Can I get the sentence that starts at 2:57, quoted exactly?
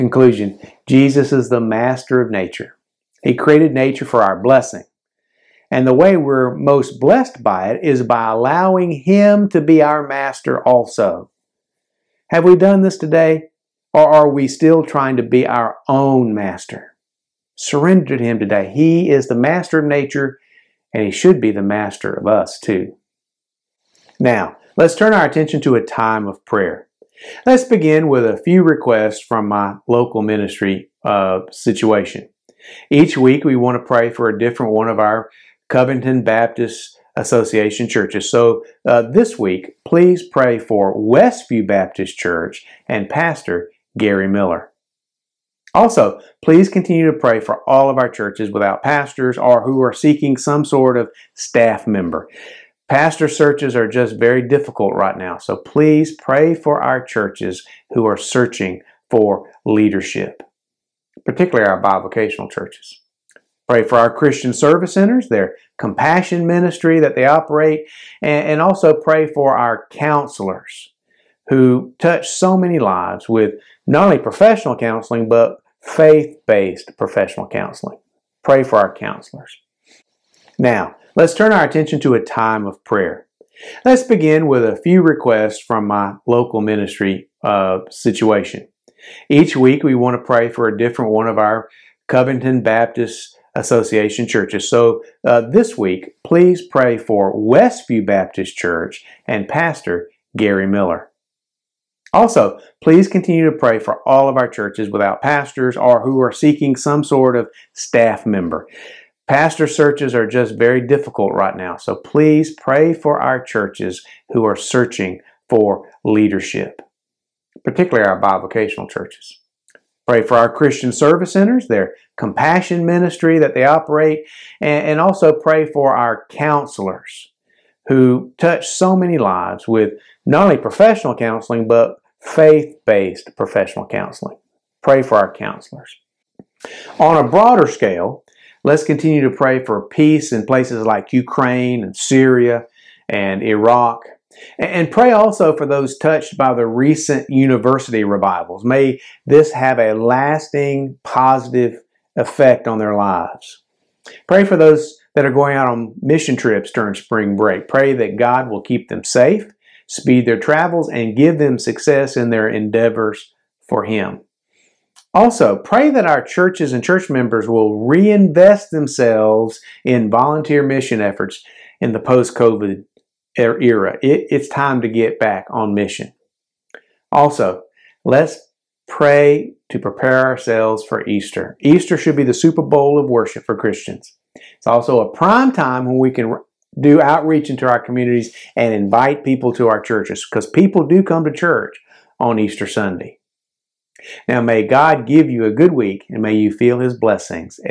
Also, let's pray to prepare ourselves for Easter.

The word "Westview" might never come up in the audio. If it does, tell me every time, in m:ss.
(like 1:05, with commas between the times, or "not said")
0:40, 1:37.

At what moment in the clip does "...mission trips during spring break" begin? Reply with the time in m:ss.
2:35.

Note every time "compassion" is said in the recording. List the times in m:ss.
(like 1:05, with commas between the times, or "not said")
1:05, 2:02.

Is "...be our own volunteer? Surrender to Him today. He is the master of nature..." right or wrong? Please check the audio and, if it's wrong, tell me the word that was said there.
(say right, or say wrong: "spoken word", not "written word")
wrong: "master", not "volunteer".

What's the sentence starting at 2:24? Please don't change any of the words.
And pray also for those touched by the recent university revivals.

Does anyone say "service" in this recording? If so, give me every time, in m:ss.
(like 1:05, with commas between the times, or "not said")
1:04, 2:00.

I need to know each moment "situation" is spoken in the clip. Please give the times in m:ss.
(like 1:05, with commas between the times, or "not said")
0:31, 1:27.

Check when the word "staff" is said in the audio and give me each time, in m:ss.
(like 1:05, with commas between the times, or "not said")
0:51, 1:47.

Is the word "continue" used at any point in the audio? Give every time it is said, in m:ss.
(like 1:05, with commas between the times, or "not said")
0:46, 1:43, 2:18.